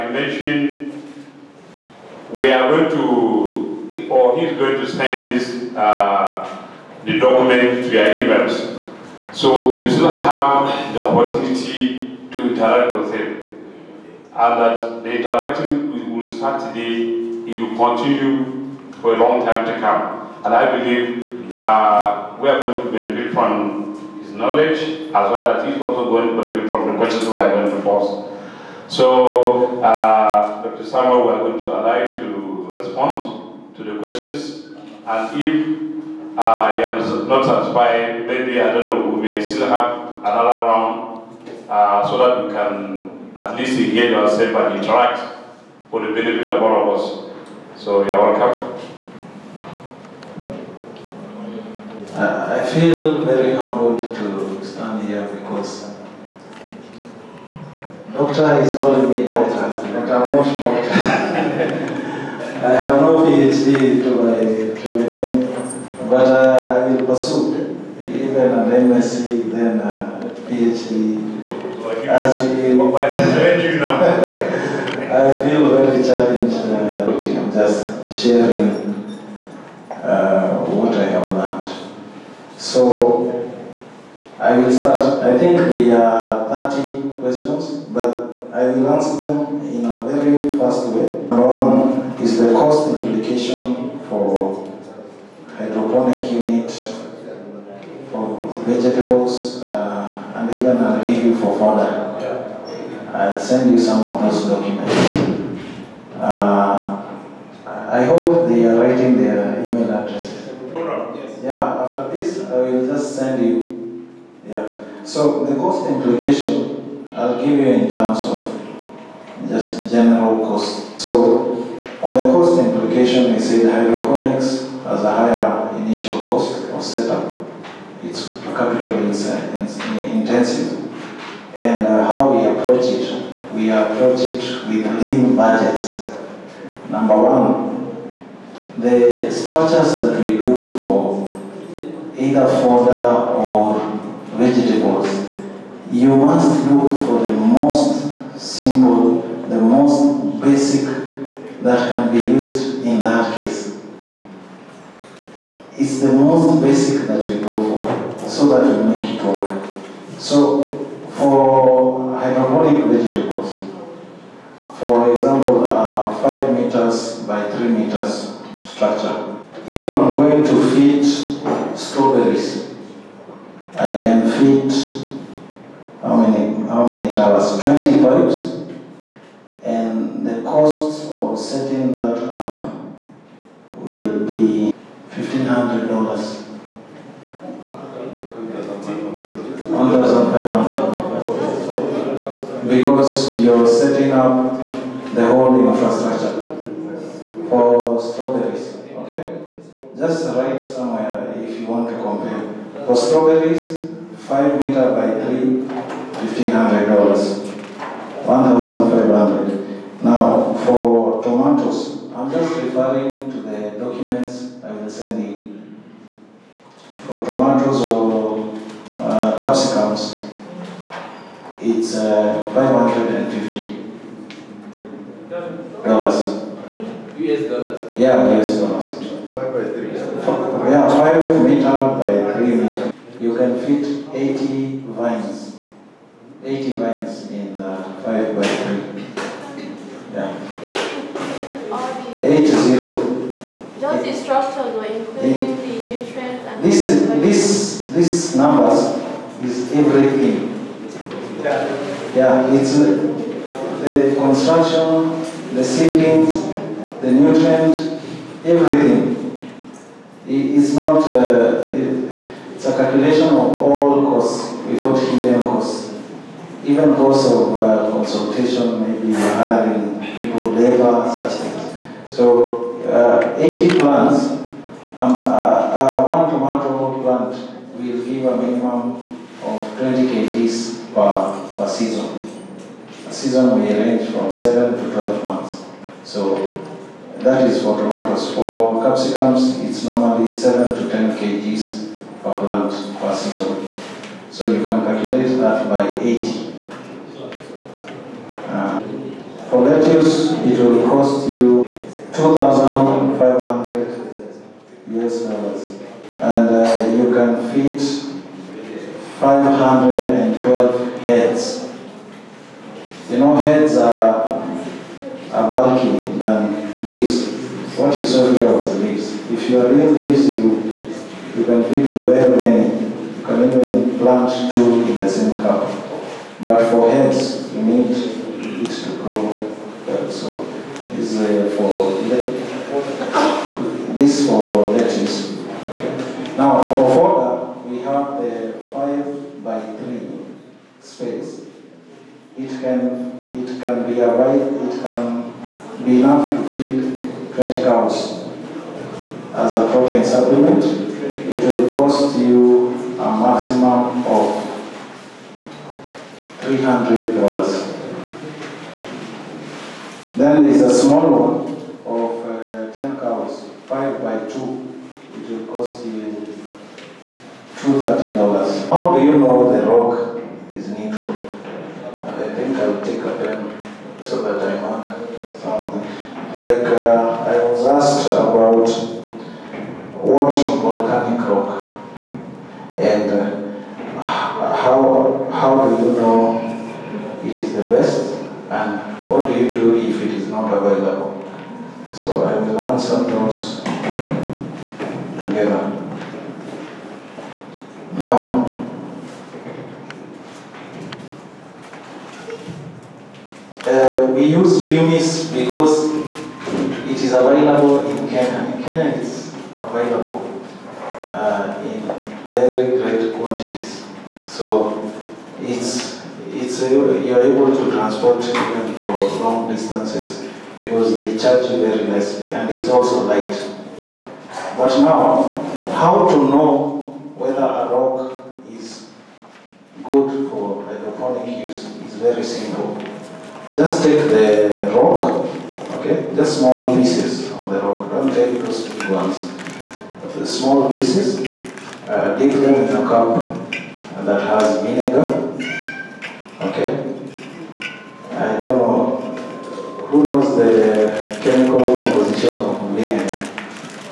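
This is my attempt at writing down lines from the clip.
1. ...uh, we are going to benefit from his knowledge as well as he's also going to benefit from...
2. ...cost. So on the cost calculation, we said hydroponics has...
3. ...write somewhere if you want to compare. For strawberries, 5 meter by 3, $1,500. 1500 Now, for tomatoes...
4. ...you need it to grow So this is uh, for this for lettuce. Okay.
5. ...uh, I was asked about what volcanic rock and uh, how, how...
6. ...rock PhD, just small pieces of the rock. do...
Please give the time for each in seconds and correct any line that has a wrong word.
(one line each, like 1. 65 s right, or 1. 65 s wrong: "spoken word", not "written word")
1. 21 s right
2. 120 s wrong: "implication", not "calculation"
3. 200 s right
4. 327 s right
5. 376 s right
6. 434 s wrong: "Okay", not "PhD".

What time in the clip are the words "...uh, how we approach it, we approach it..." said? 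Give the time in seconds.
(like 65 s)
131 s.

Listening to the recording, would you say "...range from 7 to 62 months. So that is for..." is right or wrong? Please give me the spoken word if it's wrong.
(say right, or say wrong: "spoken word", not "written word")
wrong: "12", not "62".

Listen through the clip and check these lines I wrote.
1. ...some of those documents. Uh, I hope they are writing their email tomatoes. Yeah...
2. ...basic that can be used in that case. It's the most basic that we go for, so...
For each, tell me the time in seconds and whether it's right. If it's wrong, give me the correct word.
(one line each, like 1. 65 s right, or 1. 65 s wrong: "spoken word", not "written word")
1. 103 s wrong: "addresses", not "tomatoes"
2. 150 s right.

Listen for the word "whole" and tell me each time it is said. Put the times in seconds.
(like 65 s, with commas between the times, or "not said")
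195 s.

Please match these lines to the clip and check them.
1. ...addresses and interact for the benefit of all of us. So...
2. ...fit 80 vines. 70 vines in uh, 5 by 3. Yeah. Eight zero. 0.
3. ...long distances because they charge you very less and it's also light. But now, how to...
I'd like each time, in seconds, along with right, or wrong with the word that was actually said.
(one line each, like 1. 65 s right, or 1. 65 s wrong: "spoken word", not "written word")
1. 44 s wrong: "ourselves", not "addresses"
2. 233 s wrong: "80", not "70"
3. 419 s right.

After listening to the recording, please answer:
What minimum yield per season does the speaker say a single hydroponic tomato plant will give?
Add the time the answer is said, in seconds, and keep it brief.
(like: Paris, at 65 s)
20 kg, at 279 s.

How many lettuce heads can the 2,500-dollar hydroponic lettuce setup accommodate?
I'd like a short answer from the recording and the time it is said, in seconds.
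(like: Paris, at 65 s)
512, at 309 s.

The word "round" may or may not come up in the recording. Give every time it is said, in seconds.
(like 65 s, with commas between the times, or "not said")
40 s.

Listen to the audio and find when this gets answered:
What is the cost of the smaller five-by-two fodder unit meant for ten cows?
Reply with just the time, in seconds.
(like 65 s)
367 s.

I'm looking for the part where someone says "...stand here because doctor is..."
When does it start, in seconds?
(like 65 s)
54 s.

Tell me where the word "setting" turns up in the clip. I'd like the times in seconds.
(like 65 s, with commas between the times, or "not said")
181 s, 193 s.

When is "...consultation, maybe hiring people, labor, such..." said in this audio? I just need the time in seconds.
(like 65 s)
267 s.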